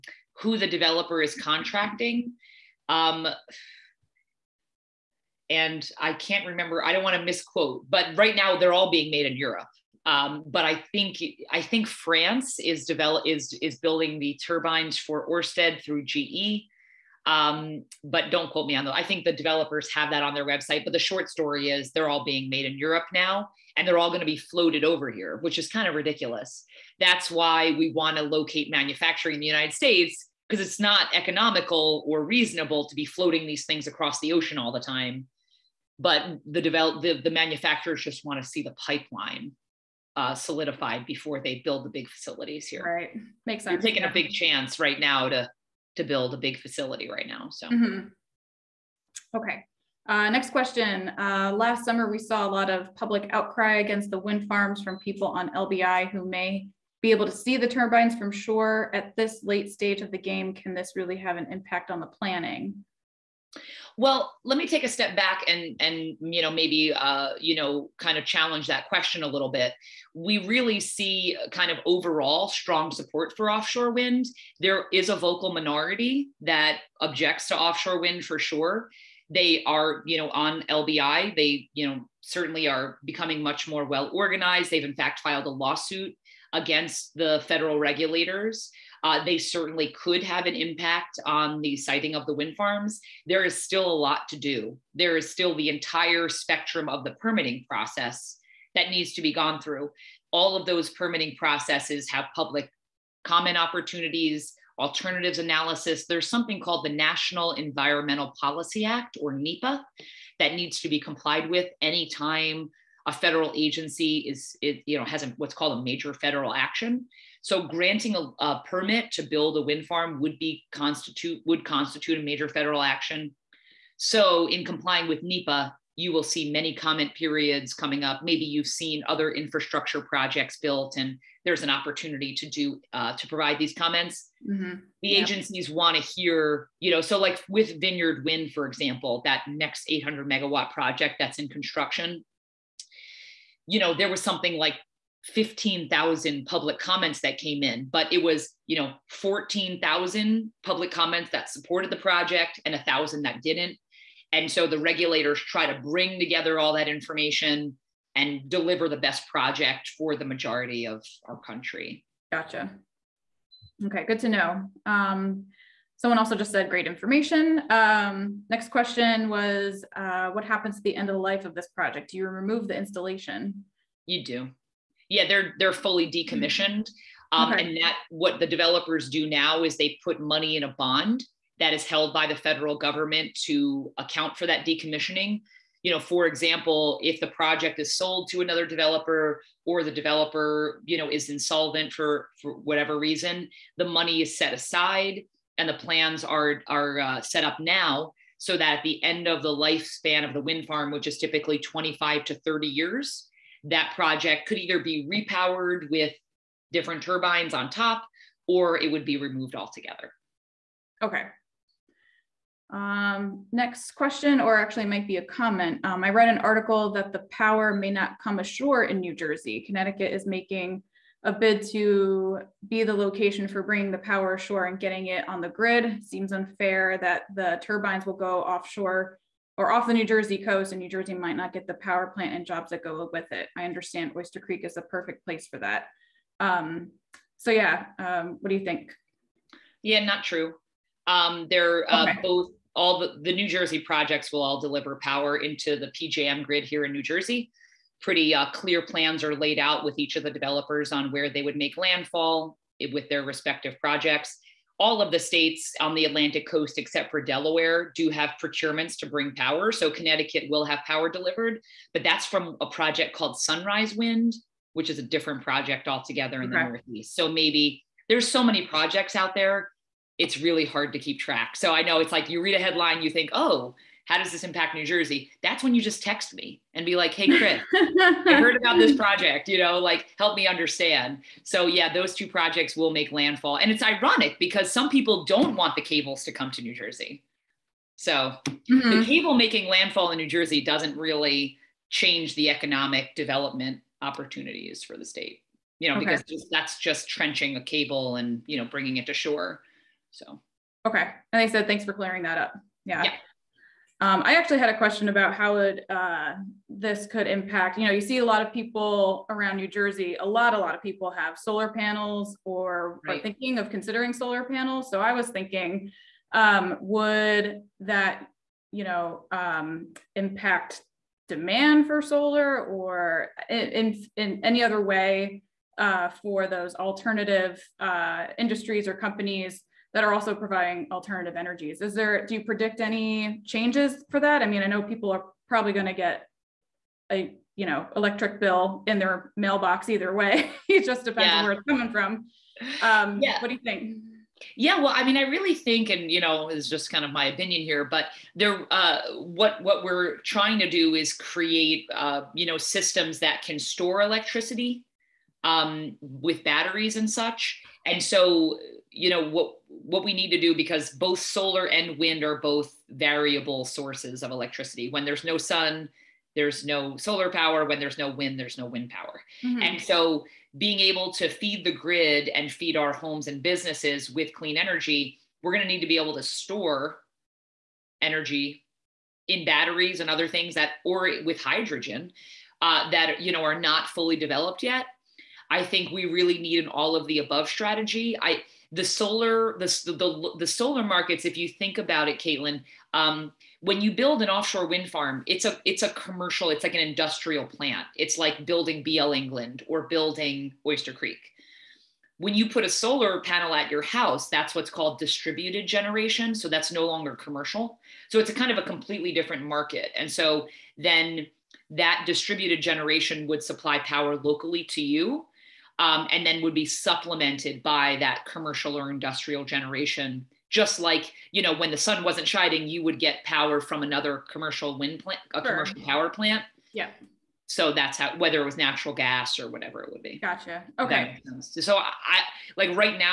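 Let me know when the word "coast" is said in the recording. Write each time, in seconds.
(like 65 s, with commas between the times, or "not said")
230 s, 256 s.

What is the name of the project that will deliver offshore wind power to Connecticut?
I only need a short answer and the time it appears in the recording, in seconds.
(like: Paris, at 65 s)
Sunrise Wind, at 263 s.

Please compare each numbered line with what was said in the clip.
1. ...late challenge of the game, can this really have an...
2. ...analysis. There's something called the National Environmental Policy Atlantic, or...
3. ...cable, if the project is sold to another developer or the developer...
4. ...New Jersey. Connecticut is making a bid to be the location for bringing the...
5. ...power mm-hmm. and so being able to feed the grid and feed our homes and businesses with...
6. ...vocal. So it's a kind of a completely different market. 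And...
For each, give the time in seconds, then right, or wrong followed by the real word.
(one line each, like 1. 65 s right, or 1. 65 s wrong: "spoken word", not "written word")
1. 59 s wrong: "stage", not "challenge"
2. 105 s wrong: "Act", not "Atlantic"
3. 186 s wrong: "example", not "cable"
4. 218 s right
5. 368 s right
6. 407 s wrong: "commercial", not "vocal".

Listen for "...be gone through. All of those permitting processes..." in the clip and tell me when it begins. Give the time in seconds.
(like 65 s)
99 s.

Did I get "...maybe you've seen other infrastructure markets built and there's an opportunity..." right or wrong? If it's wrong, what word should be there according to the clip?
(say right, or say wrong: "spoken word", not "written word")
wrong: "projects", not "markets".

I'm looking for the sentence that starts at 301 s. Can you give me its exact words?
And I said, thanks for clearing that up.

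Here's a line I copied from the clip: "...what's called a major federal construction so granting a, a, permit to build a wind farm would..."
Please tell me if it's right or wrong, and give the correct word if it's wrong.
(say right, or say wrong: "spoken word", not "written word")
wrong: "action", not "construction".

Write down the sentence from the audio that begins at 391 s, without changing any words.
If you think about it, Caitlin, um, when you build an offshore wind farm, it's a it's a commercial.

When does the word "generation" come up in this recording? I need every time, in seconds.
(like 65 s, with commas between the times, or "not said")
405 s, 412 s, 419 s.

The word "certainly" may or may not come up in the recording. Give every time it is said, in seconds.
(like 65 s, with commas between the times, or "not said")
82 s, 89 s.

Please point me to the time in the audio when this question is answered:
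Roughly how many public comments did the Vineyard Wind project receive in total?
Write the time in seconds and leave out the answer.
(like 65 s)
145 s.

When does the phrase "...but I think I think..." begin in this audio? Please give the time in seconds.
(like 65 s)
10 s.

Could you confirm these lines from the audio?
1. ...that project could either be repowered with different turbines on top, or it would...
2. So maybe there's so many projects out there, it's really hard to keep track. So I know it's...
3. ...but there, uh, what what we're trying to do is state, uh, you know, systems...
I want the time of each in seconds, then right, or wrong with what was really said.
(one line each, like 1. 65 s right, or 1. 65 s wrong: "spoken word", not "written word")
1. 203 s right
2. 267 s right
3. 347 s wrong: "create", not "state".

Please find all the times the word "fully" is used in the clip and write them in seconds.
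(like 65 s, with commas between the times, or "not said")
175 s, 383 s.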